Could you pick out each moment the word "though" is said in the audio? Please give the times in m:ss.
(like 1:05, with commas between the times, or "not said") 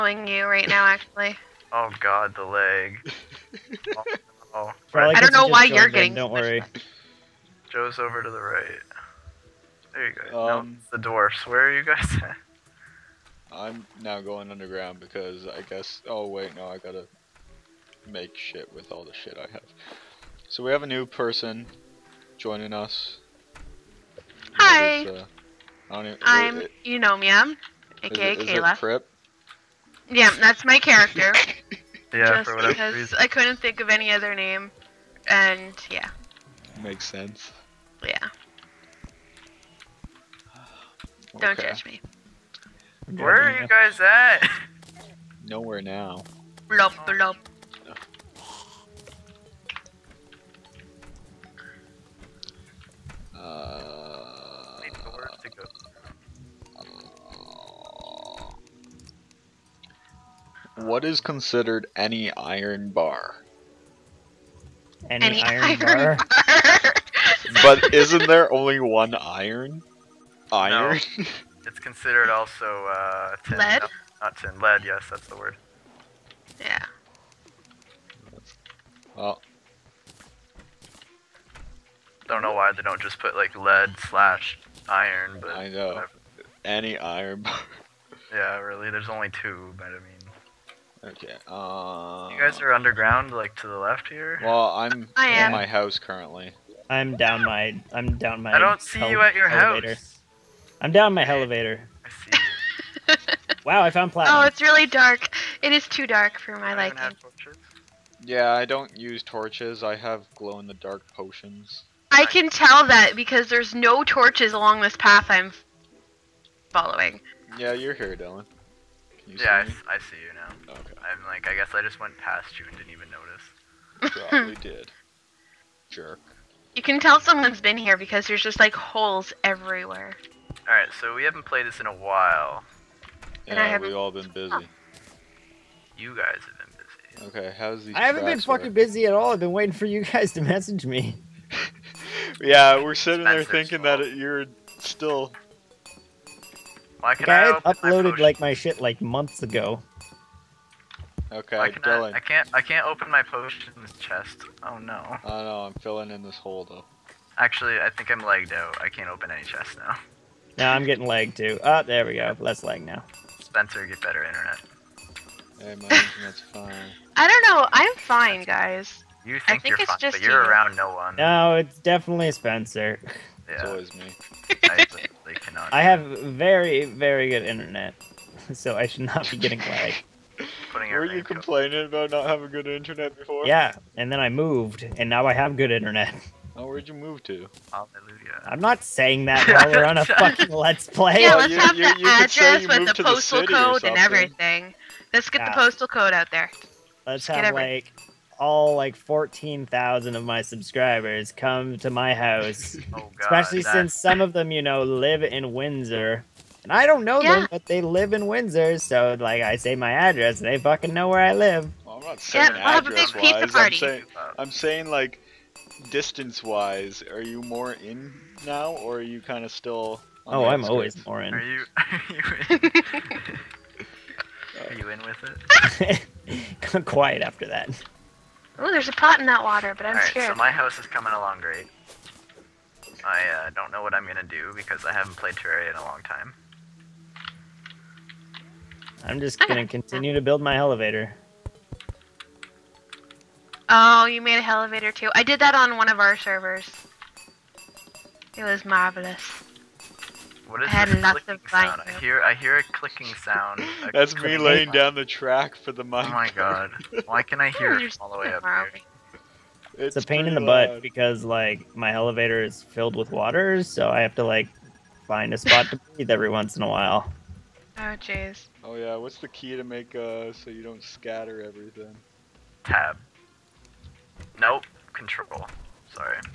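2:36.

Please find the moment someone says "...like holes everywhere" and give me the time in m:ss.
2:08.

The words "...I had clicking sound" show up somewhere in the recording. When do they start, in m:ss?
4:10.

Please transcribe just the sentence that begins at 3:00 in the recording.
Were you complaining about not having good internet before?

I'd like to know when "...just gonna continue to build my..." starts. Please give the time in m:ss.
3:59.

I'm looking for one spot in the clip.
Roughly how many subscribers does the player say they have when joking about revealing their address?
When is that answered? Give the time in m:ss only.
3:18.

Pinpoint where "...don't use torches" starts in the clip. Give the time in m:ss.
1:48.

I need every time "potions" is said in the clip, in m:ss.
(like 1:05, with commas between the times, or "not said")
1:51, 2:33.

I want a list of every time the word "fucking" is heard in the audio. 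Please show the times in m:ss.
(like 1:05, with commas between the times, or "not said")
2:18, 3:10, 3:30.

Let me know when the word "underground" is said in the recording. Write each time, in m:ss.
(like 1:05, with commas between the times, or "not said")
0:14, 1:32.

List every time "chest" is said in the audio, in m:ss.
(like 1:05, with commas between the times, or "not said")
2:33, 2:39.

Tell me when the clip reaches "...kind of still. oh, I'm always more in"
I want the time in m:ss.
3:39.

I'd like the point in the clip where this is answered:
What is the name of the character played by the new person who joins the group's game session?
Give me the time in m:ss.
0:26.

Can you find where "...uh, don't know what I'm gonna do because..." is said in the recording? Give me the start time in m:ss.
3:53.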